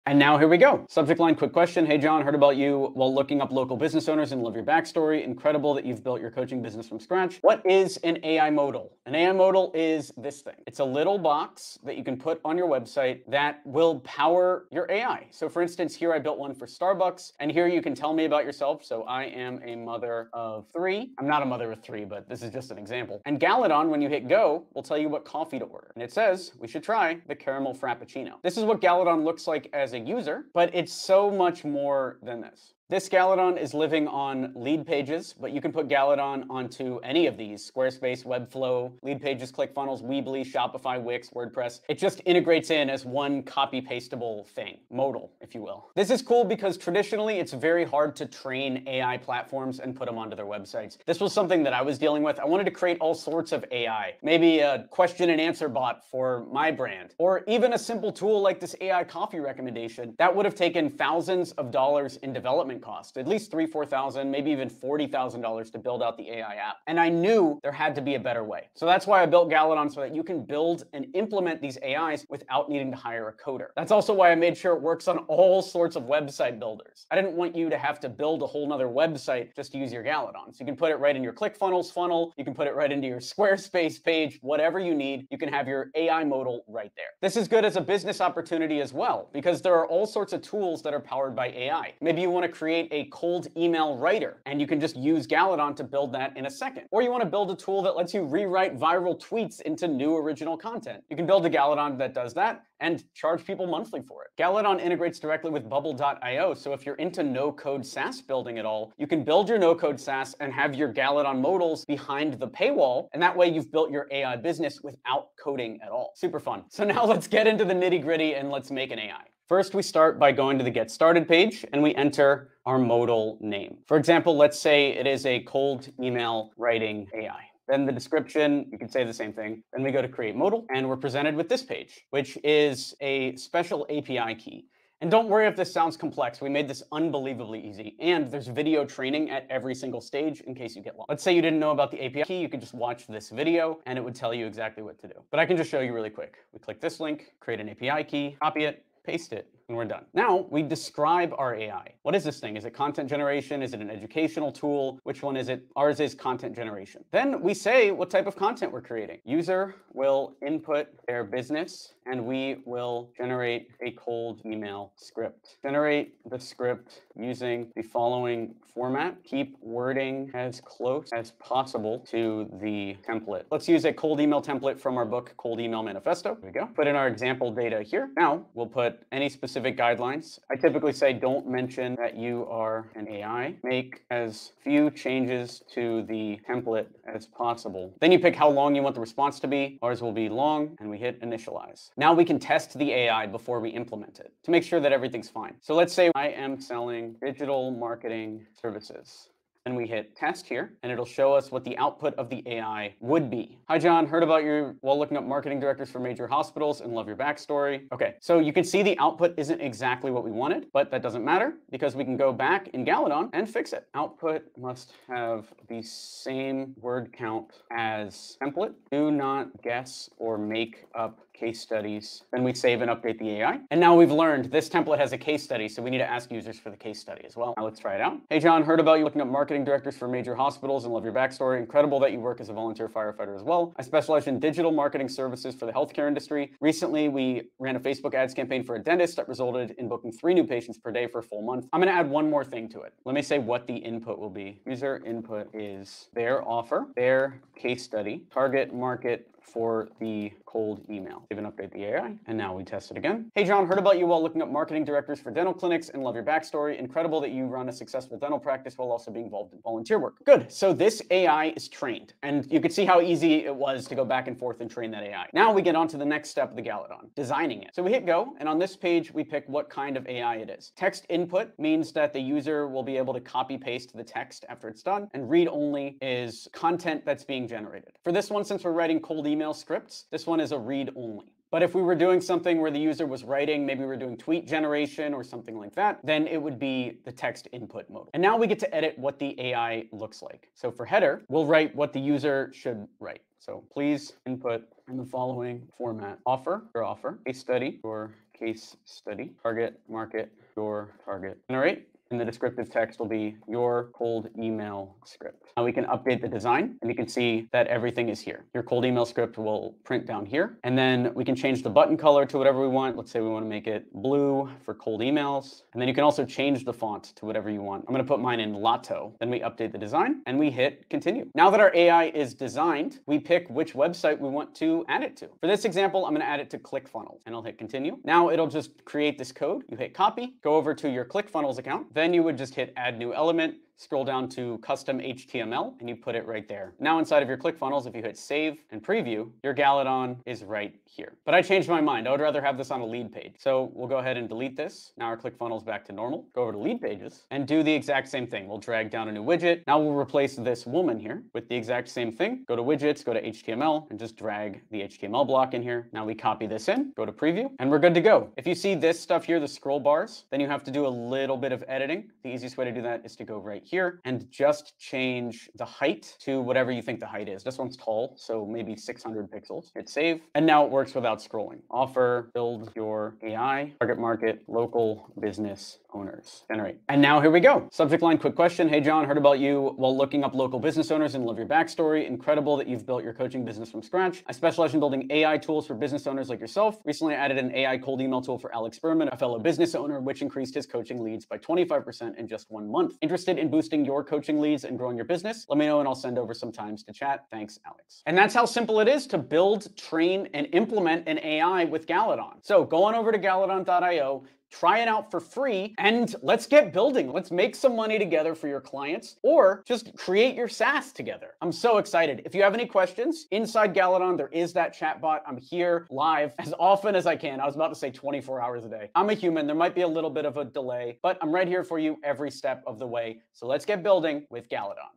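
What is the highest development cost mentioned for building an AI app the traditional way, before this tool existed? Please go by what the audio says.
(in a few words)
$40,000.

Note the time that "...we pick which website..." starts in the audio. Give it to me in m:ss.
5:23.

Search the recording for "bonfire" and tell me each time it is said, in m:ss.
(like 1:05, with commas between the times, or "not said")
not said.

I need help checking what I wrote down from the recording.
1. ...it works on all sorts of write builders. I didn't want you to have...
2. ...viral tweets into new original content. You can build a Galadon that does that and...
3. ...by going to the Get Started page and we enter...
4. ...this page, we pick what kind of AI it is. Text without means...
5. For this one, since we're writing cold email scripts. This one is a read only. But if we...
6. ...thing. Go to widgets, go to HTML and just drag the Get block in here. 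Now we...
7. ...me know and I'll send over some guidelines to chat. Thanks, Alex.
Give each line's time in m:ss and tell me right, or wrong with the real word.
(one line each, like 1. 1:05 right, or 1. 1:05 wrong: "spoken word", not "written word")
1. 1:14 wrong: "website", not "write"
2. 1:38 right
3. 2:00 right
4. 4:28 wrong: "input", not "without"
5. 4:38 right
6. 5:52 wrong: "HTML", not "Get"
7. 6:35 wrong: "times", not "guidelines".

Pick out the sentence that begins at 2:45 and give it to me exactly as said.
Generate the script using the following format.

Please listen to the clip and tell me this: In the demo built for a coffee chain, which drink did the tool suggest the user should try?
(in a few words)
caramel frappuccino.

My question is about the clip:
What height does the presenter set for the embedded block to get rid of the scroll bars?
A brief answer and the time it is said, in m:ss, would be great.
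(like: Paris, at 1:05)
600 pixels, at 6:08.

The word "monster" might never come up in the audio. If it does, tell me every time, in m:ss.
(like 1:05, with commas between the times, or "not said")
not said.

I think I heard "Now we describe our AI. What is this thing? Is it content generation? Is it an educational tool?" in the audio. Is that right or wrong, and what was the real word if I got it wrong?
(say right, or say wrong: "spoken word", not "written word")
right.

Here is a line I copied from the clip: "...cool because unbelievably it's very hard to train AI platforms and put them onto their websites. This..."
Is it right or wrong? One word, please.
wrong.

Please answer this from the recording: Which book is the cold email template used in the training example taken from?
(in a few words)
Cold Email Manifesto.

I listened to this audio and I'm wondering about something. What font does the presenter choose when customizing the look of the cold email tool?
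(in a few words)
Lato.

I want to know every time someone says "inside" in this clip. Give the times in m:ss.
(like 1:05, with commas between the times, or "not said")
5:36, 6:53.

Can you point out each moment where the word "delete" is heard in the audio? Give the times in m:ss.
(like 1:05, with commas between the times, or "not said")
5:44.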